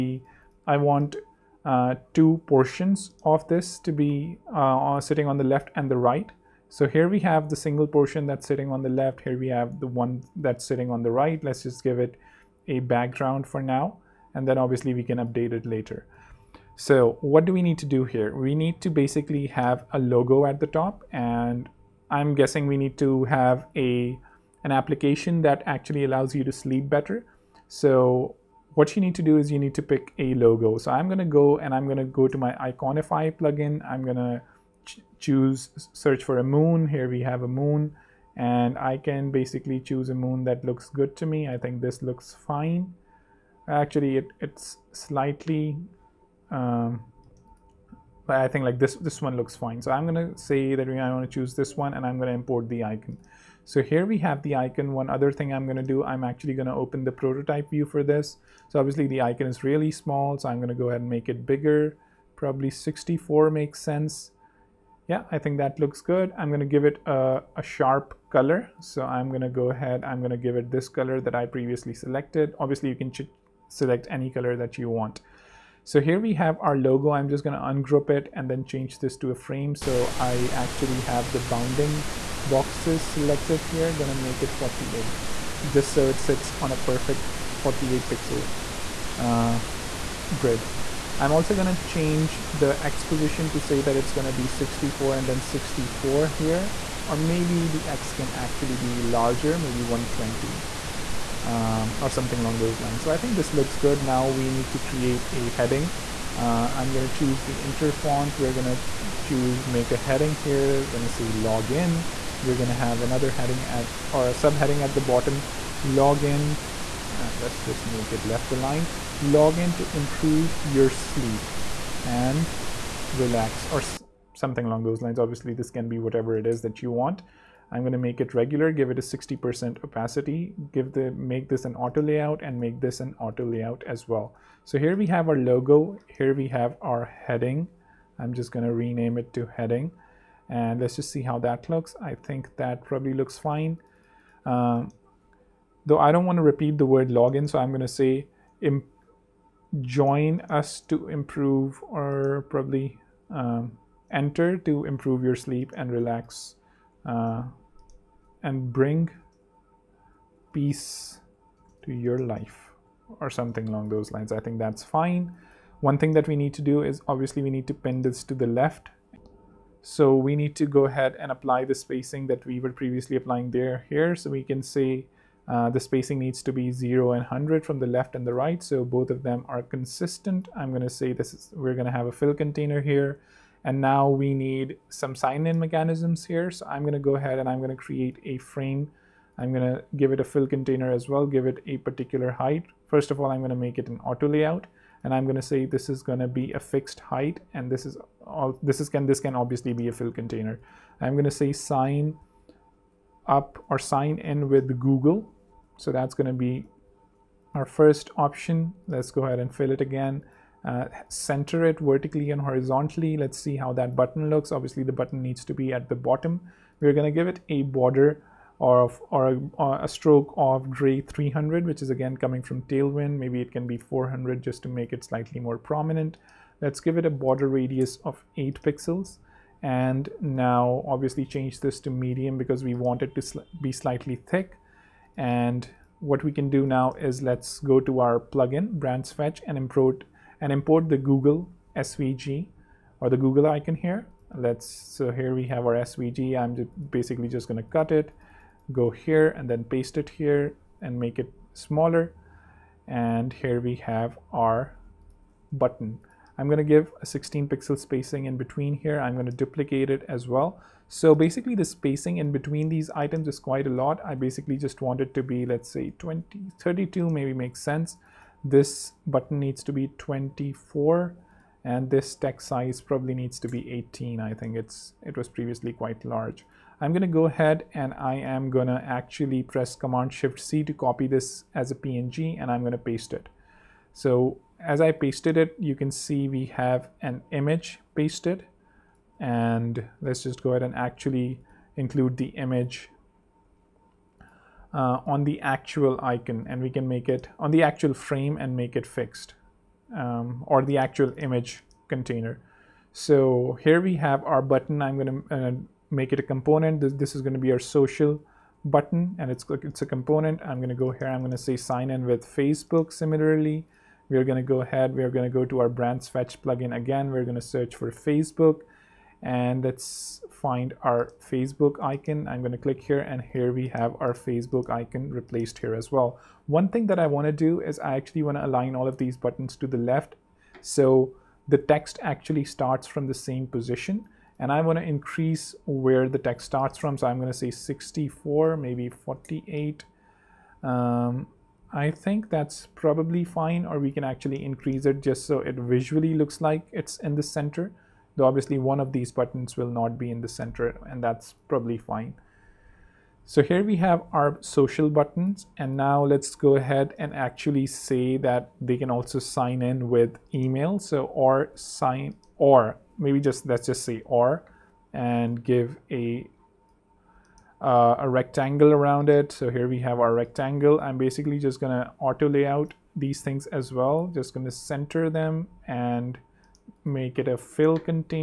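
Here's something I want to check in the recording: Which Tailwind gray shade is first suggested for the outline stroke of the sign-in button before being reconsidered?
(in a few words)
gray 300.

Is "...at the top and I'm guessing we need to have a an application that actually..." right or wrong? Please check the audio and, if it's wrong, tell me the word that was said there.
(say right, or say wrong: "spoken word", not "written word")
right.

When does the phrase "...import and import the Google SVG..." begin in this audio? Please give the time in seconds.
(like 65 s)
239 s.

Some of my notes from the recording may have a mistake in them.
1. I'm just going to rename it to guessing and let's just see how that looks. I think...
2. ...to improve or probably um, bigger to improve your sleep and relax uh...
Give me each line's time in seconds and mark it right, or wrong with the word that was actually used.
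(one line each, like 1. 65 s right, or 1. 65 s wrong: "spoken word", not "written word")
1. 138 s wrong: "heading", not "guessing"
2. 150 s wrong: "enter", not "bigger".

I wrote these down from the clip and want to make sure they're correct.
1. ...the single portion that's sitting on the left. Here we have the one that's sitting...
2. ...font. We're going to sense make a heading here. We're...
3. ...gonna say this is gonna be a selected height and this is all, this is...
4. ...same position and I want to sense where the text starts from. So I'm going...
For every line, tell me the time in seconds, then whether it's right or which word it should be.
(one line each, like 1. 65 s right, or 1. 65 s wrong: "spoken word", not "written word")
1. 7 s right
2. 107 s wrong: "choose", not "sense"
3. 195 s wrong: "fixed", not "selected"
4. 333 s wrong: "increase", not "sense".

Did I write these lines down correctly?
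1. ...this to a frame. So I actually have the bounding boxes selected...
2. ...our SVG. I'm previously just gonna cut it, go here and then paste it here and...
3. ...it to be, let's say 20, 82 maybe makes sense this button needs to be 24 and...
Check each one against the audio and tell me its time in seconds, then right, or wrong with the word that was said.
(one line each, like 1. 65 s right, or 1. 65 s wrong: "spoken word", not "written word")
1. 78 s right
2. 245 s wrong: "basically", not "previously"
3. 264 s wrong: "32", not "82".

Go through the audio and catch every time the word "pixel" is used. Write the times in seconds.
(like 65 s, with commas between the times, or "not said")
88 s, 228 s, 257 s.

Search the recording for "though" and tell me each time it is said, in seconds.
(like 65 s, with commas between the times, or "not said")
145 s, 348 s.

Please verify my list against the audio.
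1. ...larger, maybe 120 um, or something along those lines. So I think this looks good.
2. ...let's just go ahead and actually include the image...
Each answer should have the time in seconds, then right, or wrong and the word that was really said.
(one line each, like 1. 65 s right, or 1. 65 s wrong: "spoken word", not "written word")
1. 98 s right
2. 289 s right.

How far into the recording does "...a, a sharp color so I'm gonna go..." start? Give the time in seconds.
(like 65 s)
67 s.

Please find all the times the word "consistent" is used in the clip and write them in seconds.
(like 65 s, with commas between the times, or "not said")
179 s.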